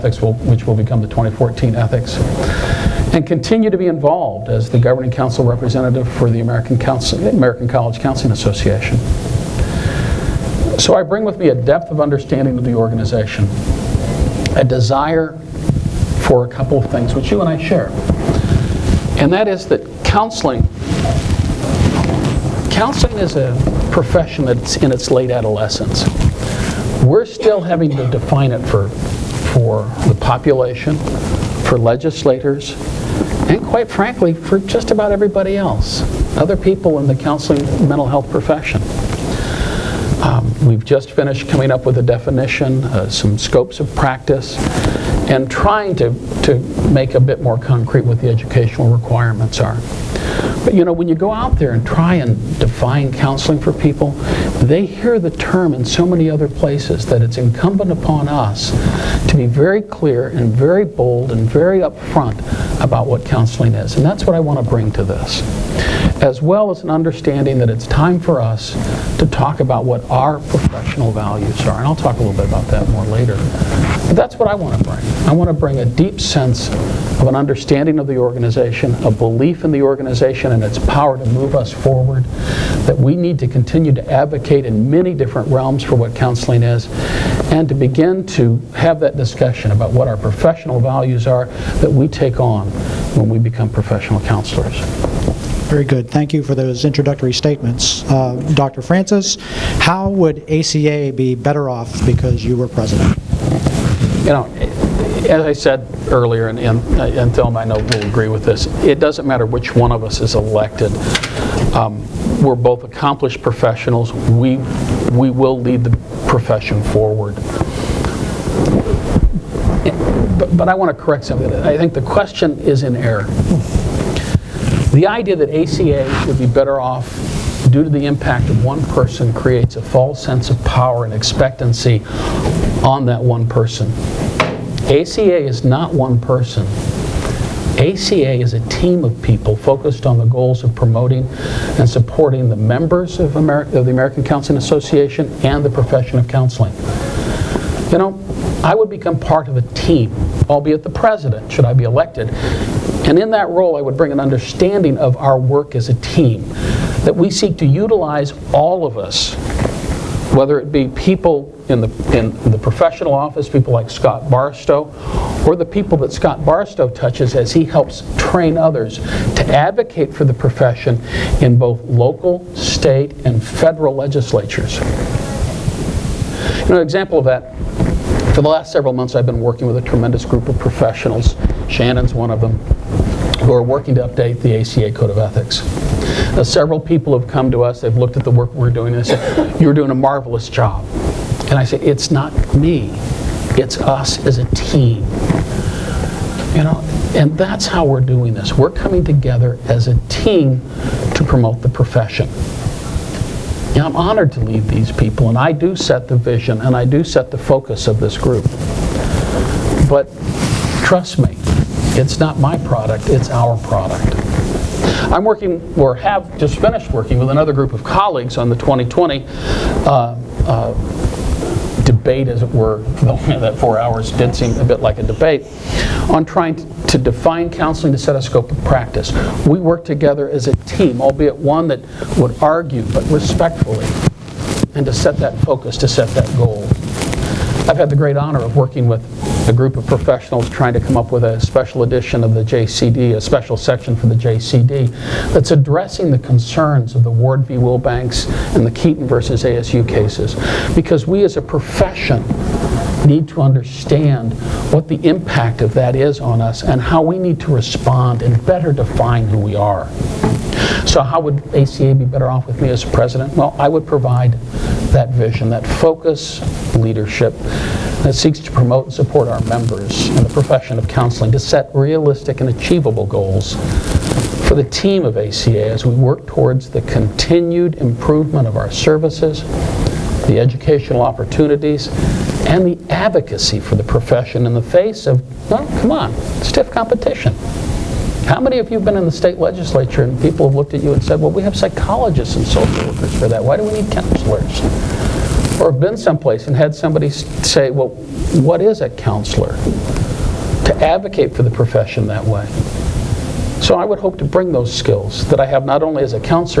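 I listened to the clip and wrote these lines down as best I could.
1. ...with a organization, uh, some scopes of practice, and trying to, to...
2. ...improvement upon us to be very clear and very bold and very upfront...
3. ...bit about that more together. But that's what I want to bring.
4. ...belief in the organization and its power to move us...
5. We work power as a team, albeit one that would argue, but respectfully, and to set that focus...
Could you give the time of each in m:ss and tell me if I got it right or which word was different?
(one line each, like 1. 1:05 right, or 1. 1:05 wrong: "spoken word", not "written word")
1. 0:41 wrong: "definition", not "organization"
2. 0:57 wrong: "incumbent", not "improvement"
3. 1:12 wrong: "later", not "together"
4. 1:19 right
5. 3:49 wrong: "together", not "power".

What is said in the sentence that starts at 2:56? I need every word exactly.
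You know, an example of that for the last several months, I've been working with a tremendous group of professionals.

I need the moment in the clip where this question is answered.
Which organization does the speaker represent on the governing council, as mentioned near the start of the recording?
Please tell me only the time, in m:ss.
0:07.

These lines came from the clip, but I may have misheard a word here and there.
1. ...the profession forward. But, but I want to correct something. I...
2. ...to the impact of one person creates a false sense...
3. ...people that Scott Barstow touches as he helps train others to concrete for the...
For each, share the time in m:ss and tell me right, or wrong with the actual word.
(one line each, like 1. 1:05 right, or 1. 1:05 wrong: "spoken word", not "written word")
1. 1:55 right
2. 2:07 right
3. 2:45 wrong: "advocate", not "concrete".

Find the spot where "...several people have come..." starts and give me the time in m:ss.
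3:06.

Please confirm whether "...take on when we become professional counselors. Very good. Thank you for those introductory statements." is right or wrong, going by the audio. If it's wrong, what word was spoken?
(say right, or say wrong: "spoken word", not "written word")
right.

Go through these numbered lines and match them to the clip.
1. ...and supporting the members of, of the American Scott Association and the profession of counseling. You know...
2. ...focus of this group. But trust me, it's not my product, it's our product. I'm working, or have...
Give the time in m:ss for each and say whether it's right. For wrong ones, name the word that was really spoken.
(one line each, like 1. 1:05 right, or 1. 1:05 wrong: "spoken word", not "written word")
1. 2:21 wrong: "Counseling", not "Scott"
2. 3:27 right.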